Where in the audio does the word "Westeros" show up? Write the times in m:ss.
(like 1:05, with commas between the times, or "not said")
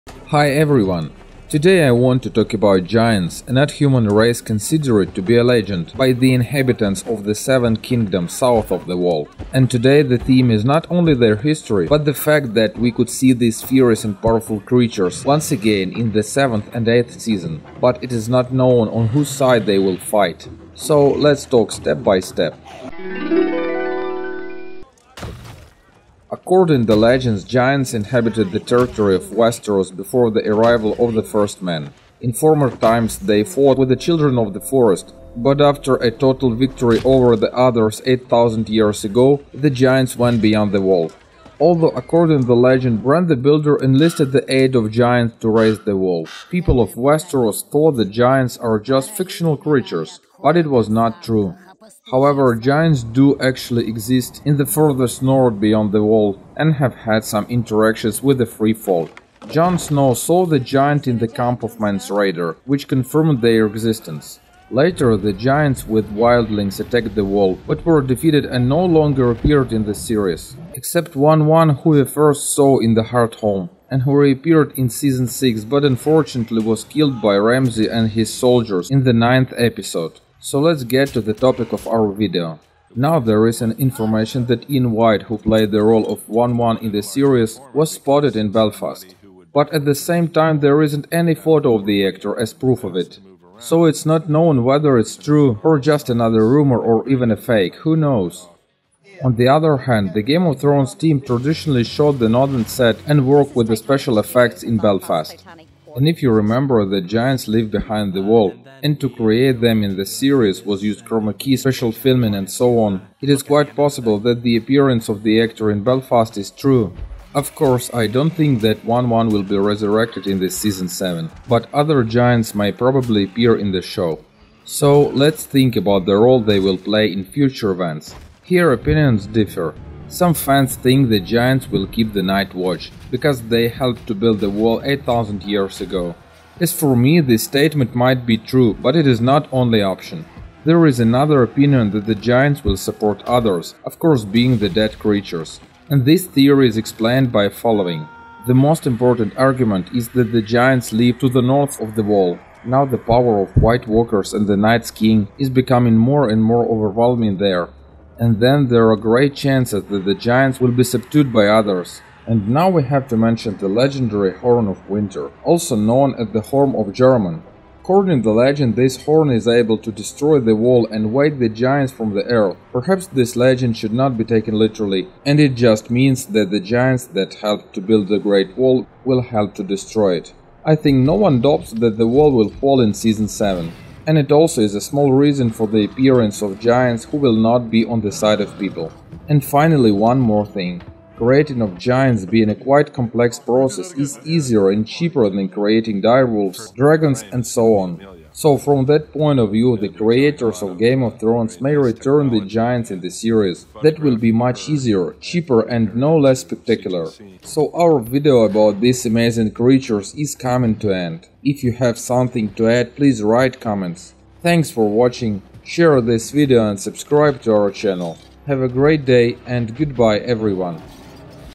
0:29, 0:46.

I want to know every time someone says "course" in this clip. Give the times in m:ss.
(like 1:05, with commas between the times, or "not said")
1:57, 2:23.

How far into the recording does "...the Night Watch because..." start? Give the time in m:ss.
2:12.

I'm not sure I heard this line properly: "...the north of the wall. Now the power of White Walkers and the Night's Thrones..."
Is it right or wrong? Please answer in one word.
wrong.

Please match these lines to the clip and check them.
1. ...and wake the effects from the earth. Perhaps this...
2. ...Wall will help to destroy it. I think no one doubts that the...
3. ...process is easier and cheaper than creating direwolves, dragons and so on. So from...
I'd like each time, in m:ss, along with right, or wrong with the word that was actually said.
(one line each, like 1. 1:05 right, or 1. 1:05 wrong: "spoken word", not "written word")
1. 2:50 wrong: "giants", not "effects"
2. 2:58 right
3. 3:13 right.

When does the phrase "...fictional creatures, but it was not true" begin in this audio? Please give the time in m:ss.
0:49.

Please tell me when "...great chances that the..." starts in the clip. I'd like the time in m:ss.
2:38.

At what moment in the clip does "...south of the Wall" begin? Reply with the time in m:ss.
0:08.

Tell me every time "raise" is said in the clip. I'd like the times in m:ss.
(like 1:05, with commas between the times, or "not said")
0:45.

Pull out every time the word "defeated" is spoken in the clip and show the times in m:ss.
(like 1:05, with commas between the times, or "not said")
1:08.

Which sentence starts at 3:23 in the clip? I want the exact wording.
That will be much easier, cheaper and no less spectacular.